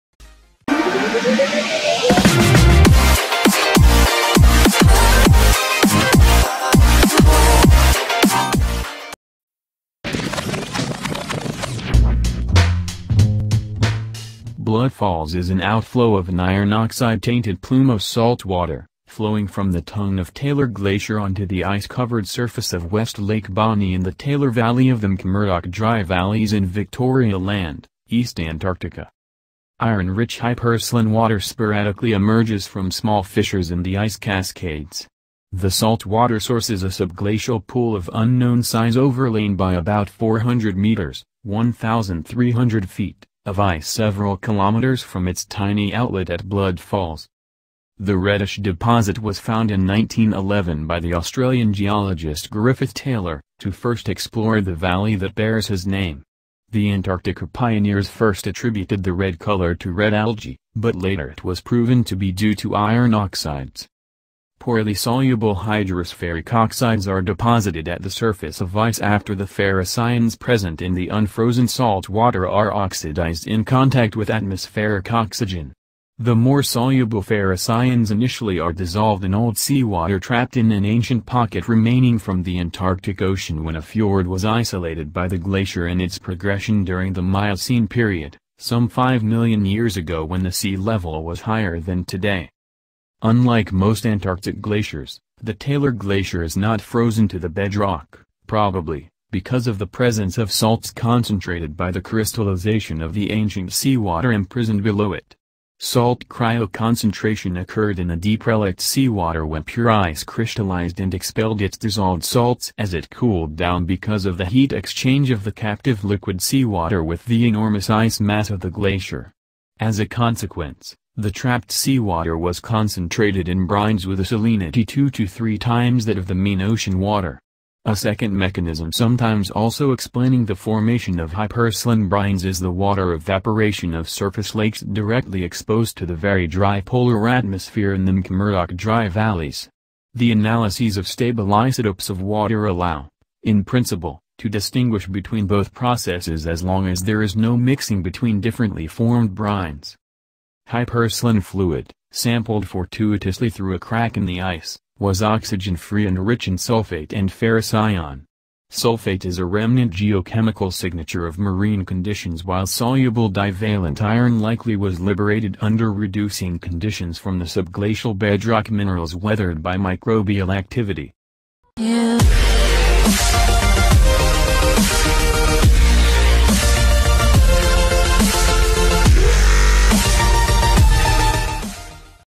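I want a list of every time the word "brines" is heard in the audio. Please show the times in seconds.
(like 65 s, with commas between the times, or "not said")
123 s, 131 s, 149 s.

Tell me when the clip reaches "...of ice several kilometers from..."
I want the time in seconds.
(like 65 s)
43 s.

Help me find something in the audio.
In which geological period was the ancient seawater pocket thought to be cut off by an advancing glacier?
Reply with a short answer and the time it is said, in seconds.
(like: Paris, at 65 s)
Miocene, at 87 s.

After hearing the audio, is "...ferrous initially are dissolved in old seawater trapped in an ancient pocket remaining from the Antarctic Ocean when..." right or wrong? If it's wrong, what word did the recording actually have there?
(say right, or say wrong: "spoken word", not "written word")
right.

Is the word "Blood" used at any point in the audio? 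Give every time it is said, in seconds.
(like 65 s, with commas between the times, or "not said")
14 s, 46 s.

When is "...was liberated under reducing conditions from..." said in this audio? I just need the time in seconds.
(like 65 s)
164 s.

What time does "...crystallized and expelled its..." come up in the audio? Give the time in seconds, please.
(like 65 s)
110 s.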